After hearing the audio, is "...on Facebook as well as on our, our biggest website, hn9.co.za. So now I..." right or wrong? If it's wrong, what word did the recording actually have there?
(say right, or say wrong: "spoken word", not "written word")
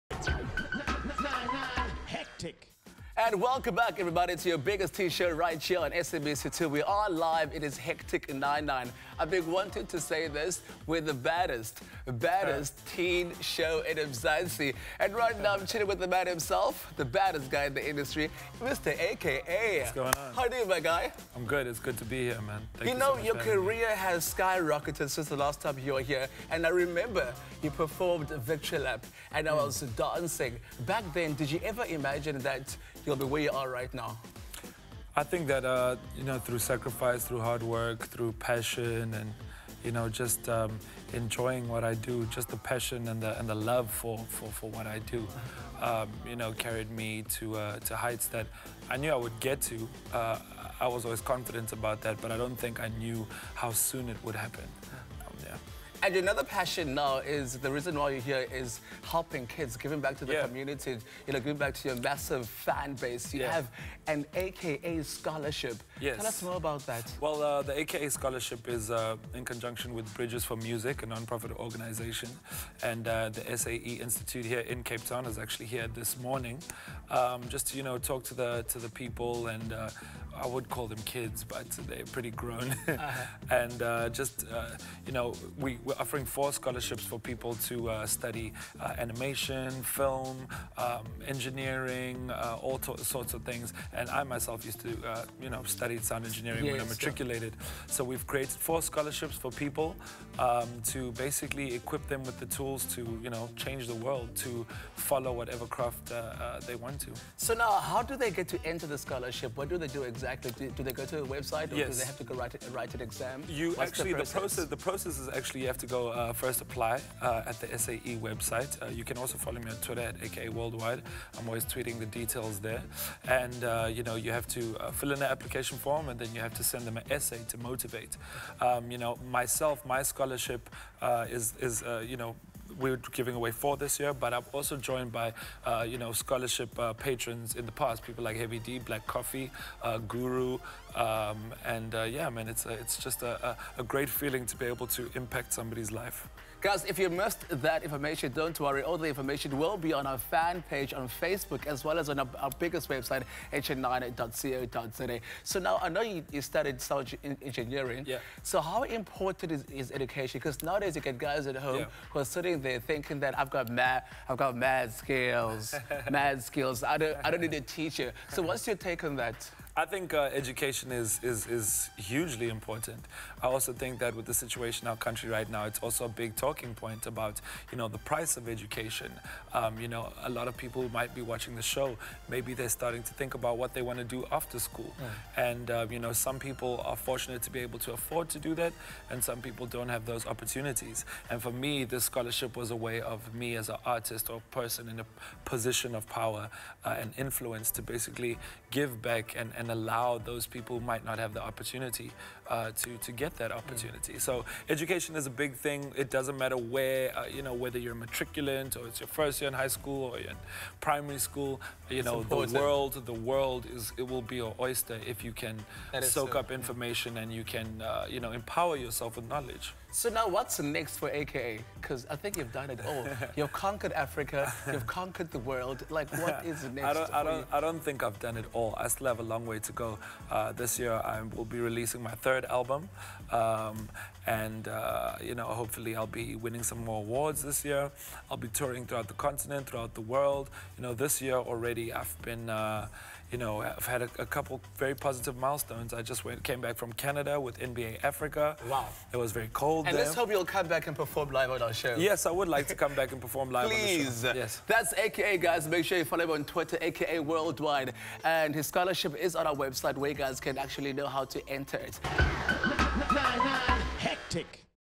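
right.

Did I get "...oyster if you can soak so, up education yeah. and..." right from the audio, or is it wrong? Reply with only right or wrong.
wrong.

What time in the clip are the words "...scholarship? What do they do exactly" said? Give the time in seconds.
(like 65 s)
108 s.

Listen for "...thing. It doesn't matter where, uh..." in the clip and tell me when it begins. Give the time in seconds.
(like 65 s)
205 s.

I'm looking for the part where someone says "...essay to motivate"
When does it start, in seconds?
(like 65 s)
127 s.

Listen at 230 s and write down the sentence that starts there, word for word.
Uh, this year I will be releasing my third album.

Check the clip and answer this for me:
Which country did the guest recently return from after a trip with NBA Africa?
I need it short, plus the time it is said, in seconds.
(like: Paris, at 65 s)
Canada, at 246 s.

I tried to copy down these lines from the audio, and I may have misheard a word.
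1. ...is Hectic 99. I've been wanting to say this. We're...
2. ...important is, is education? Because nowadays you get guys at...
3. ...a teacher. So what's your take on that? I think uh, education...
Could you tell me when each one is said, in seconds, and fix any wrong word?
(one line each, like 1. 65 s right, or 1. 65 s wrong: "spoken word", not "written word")
1. 7 s right
2. 158 s right
3. 167 s right.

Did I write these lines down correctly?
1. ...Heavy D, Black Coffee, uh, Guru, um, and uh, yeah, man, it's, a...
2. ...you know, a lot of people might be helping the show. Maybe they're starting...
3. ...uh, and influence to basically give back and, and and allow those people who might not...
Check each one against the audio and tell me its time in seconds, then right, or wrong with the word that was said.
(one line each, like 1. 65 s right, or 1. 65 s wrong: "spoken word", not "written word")
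1. 138 s right
2. 179 s wrong: "watching", not "helping"
3. 196 s right.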